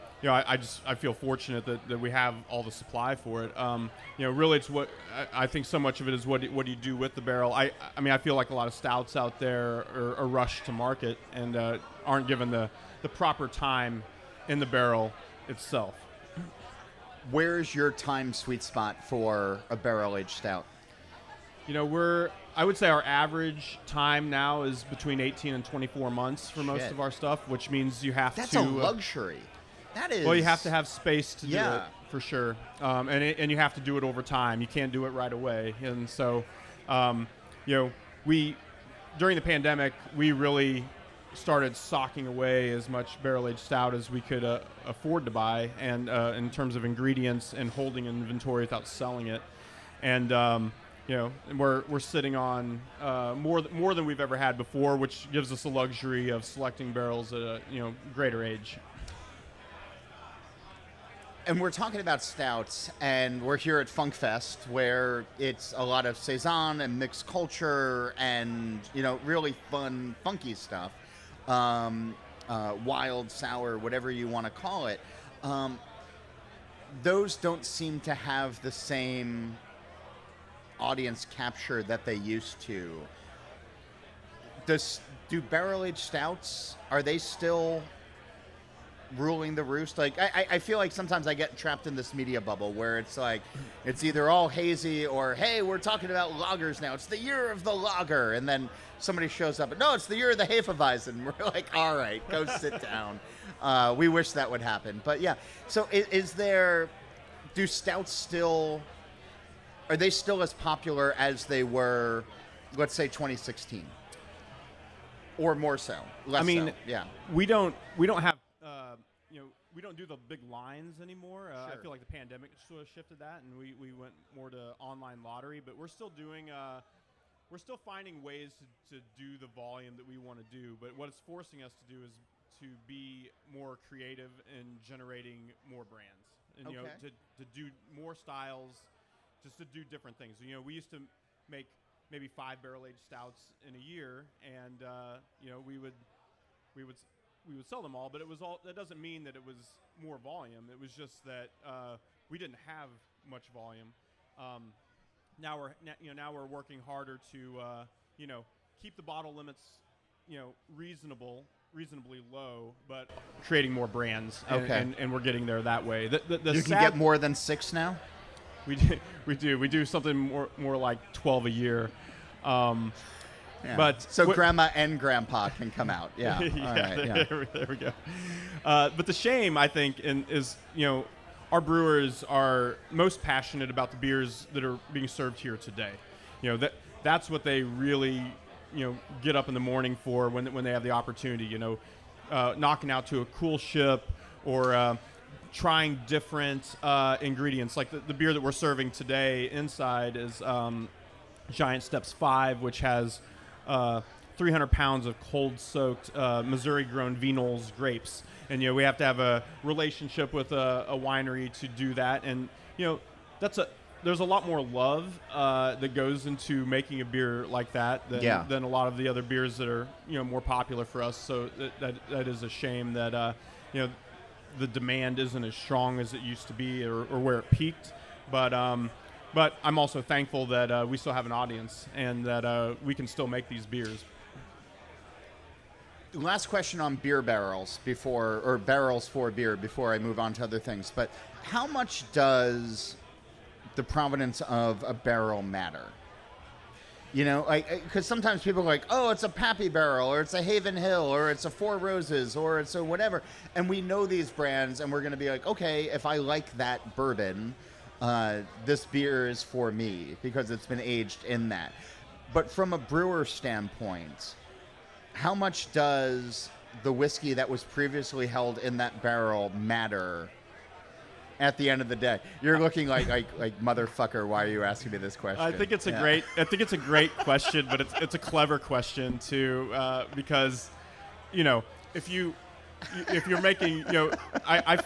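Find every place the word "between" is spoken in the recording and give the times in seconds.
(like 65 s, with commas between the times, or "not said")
24 s.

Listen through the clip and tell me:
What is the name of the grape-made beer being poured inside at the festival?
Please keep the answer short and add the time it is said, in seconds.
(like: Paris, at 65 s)
Giant Steps 5, at 201 s.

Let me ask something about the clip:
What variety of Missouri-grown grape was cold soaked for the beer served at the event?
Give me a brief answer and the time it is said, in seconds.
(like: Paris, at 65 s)
Vignoles, at 207 s.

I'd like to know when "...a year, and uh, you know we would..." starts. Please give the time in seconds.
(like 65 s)
143 s.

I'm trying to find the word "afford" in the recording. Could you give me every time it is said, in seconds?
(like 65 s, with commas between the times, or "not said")
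44 s.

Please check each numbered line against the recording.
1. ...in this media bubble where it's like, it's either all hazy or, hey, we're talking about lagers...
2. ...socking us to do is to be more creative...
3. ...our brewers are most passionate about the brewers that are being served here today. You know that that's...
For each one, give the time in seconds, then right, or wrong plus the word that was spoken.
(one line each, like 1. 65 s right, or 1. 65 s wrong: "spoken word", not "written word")
1. 91 s right
2. 131 s wrong: "forcing", not "socking"
3. 181 s wrong: "beers", not "brewers".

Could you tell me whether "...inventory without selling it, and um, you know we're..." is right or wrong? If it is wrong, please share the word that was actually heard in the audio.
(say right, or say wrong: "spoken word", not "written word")
right.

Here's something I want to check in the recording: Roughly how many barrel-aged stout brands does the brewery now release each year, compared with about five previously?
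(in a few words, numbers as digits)
12.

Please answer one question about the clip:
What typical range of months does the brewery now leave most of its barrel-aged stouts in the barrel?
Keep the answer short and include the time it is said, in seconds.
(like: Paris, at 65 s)
18 to 24 months, at 24 s.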